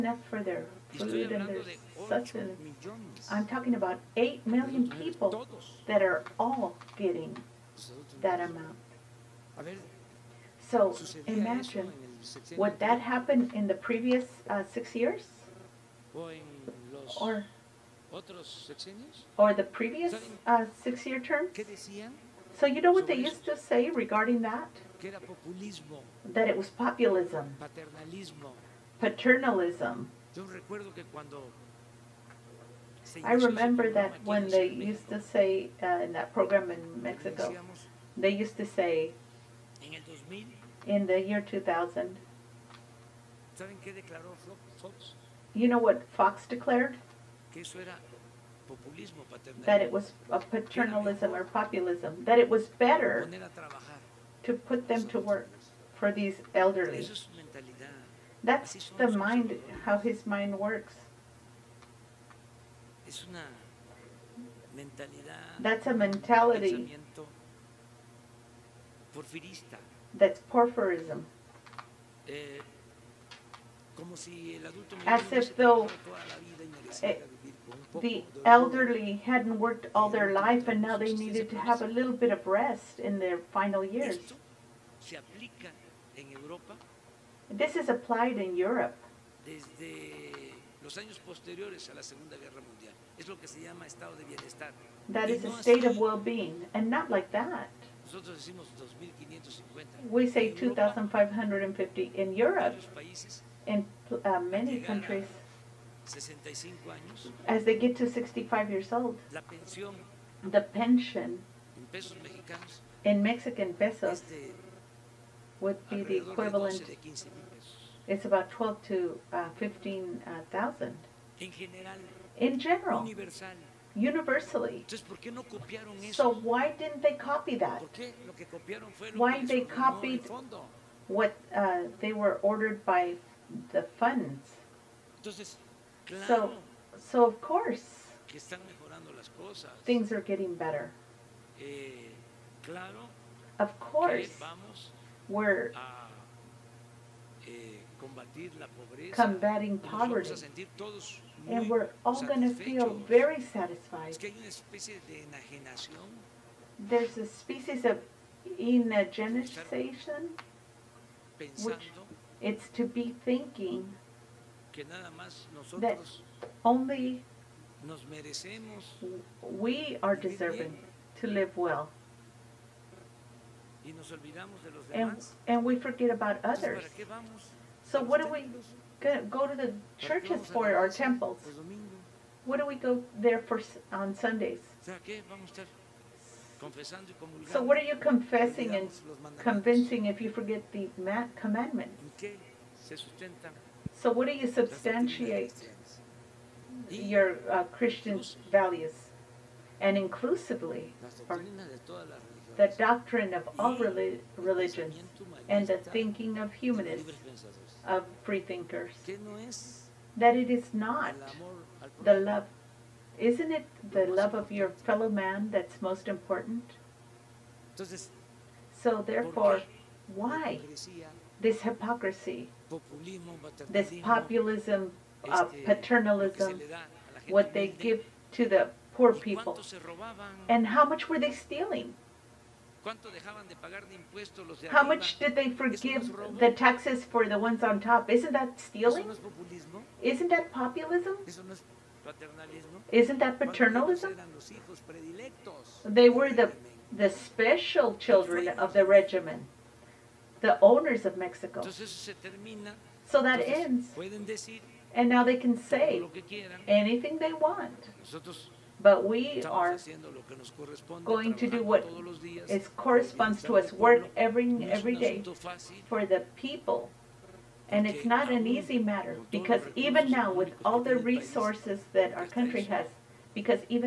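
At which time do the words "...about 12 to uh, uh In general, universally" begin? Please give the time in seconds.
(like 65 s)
118 s.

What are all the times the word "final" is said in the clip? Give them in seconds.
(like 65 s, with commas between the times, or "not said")
83 s.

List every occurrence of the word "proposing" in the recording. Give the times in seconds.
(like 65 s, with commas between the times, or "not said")
not said.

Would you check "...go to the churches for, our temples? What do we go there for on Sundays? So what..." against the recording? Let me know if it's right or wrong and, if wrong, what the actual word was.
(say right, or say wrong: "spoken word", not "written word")
right.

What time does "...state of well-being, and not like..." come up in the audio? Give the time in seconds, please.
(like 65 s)
95 s.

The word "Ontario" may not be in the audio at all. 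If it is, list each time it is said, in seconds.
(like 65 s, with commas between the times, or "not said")
not said.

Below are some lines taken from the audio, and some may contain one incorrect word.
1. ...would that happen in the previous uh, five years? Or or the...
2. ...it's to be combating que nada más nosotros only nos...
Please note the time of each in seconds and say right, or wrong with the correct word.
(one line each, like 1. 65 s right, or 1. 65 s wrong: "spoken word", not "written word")
1. 12 s wrong: "six", not "five"
2. 162 s wrong: "thinking", not "combating".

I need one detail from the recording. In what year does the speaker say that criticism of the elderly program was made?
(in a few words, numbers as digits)
2000.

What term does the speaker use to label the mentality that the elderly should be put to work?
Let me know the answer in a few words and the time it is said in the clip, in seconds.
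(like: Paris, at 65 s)
porphyrism, at 70 s.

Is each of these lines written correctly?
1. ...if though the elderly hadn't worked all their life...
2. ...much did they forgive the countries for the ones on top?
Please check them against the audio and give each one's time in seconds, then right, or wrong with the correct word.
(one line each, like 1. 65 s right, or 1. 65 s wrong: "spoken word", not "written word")
1. 75 s right
2. 234 s wrong: "taxes", not "countries".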